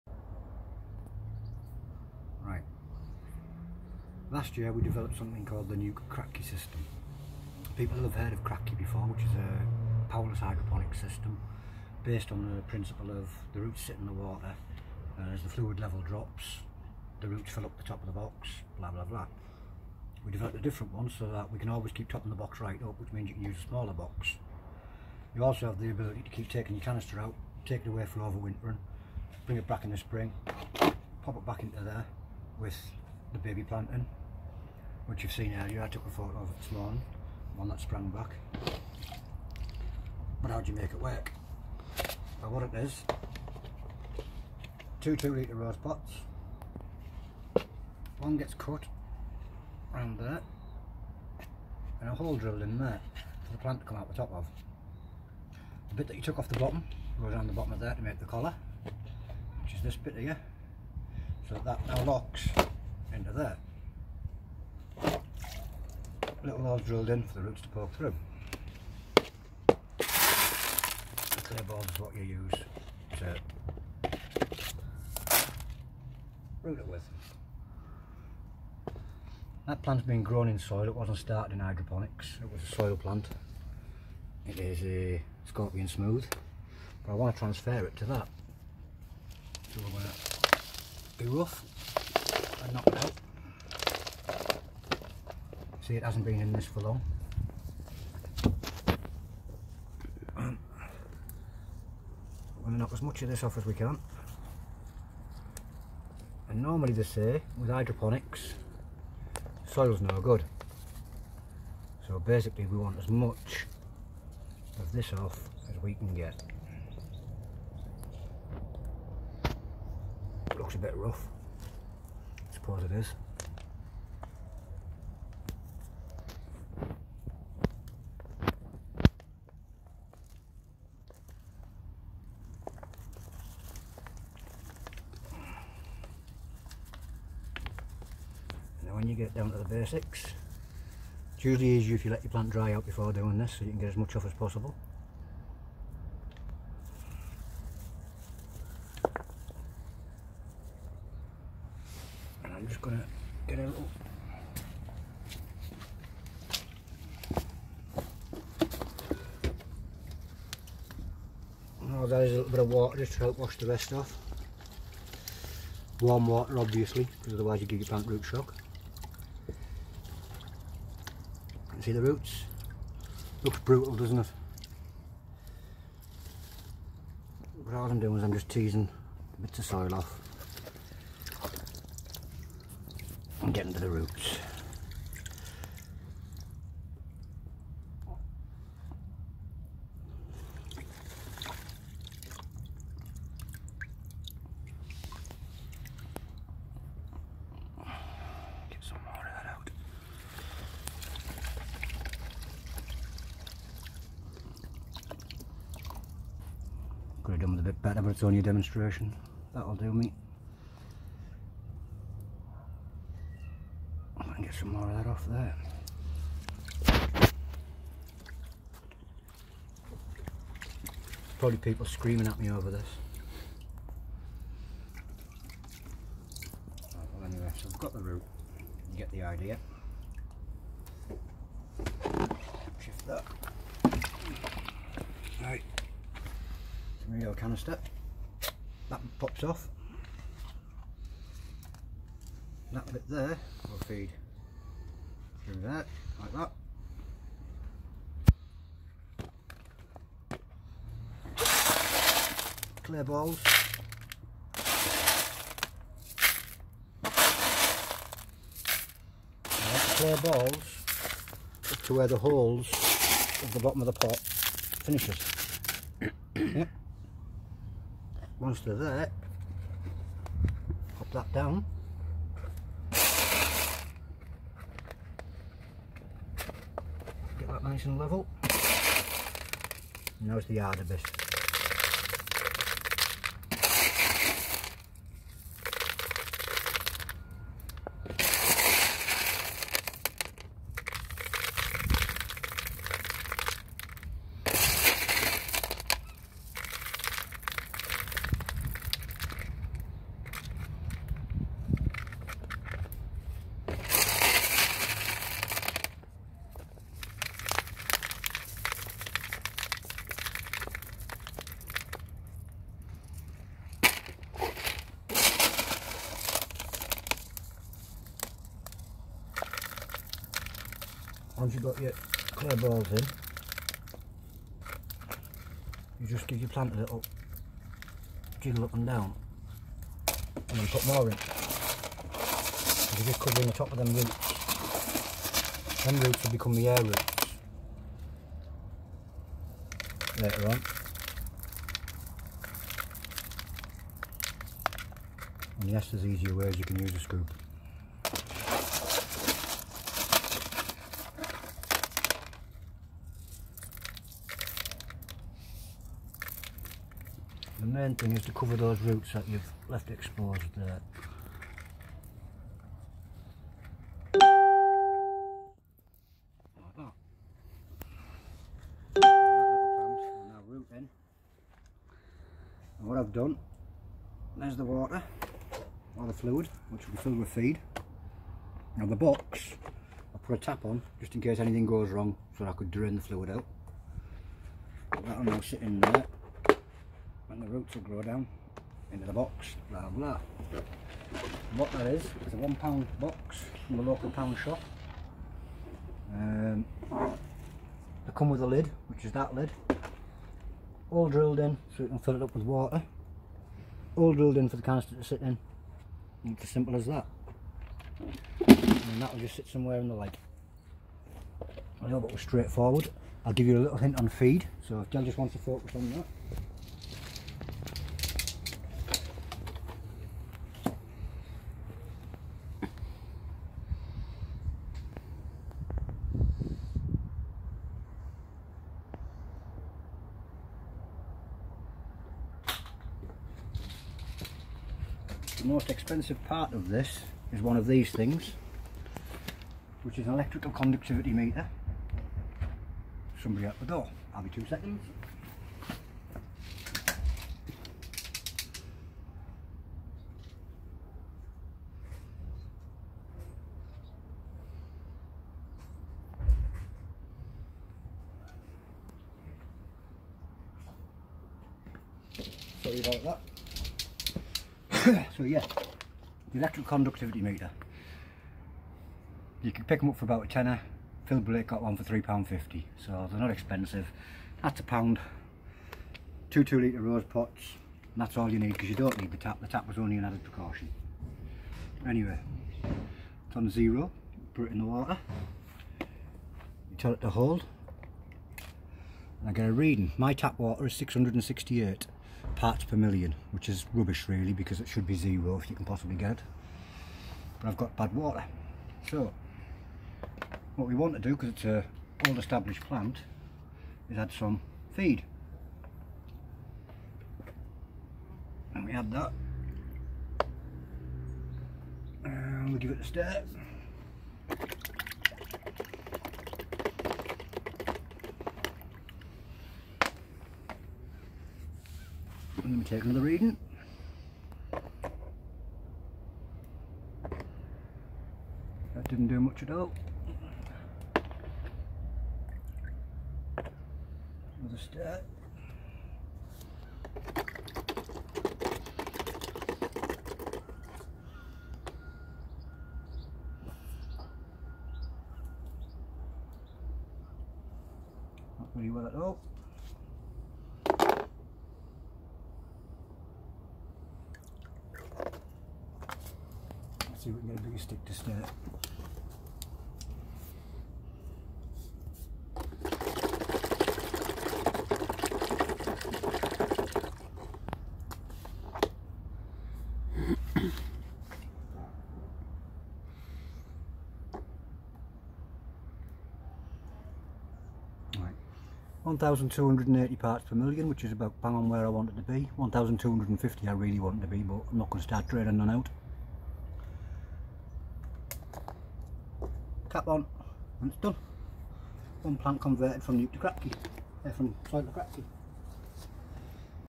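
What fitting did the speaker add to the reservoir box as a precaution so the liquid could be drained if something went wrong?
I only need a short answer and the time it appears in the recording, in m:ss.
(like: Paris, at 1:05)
A tap, at 6:20.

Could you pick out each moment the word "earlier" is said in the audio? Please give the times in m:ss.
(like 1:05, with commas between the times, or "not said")
0:35.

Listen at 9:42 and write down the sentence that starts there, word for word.
1,250 I really want it to be, but I'm not going to start draining none out.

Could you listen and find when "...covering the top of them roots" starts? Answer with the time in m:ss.
5:33.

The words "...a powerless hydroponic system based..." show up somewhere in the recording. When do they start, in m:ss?
0:09.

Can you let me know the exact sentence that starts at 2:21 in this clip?
It's usually easier if you let your plant dry out before doing this so you can get as much off as possible.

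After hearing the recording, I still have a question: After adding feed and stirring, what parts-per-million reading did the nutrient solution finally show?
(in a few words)
1,280.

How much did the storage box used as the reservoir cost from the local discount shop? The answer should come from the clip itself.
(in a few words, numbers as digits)
1 pound.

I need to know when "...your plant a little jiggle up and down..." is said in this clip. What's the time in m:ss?
5:26.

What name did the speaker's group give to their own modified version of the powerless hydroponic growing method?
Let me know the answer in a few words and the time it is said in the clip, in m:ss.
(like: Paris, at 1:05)
NEUK Kratky system, at 0:05.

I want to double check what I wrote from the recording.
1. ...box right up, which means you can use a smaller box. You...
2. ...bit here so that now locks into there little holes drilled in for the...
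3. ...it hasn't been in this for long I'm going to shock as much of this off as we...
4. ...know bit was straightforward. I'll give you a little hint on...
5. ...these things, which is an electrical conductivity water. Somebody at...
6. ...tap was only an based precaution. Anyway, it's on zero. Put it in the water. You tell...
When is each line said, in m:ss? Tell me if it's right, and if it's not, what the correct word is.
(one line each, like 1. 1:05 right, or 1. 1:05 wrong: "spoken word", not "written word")
1. 0:22 right
2. 0:59 right
3. 1:35 wrong: "knock", not "shock"
4. 6:51 right
5. 7:17 wrong: "meter", not "water"
6. 7:59 wrong: "added", not "based".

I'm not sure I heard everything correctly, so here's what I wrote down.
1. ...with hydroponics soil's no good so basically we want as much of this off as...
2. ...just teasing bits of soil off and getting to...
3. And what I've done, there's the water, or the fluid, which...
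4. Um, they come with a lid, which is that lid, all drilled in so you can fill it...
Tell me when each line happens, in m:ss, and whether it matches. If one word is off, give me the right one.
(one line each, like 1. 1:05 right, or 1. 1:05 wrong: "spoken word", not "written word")
1. 1:47 right
2. 2:58 right
3. 6:12 right
4. 6:36 right.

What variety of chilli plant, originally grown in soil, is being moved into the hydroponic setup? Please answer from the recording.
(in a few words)
Scorpion smooth.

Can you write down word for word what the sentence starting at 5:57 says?
The main thing is to cover those roots that you've left exposed there.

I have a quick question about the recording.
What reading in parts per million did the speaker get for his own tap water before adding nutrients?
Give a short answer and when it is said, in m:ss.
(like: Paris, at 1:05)
668, at 8:10.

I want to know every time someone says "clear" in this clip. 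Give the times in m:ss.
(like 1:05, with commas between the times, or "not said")
1:11, 4:12, 4:19, 5:22.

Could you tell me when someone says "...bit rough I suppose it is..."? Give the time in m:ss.
2:00.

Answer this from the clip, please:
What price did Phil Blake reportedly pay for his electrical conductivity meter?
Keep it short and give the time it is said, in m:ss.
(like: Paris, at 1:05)
£3.50, at 7:51.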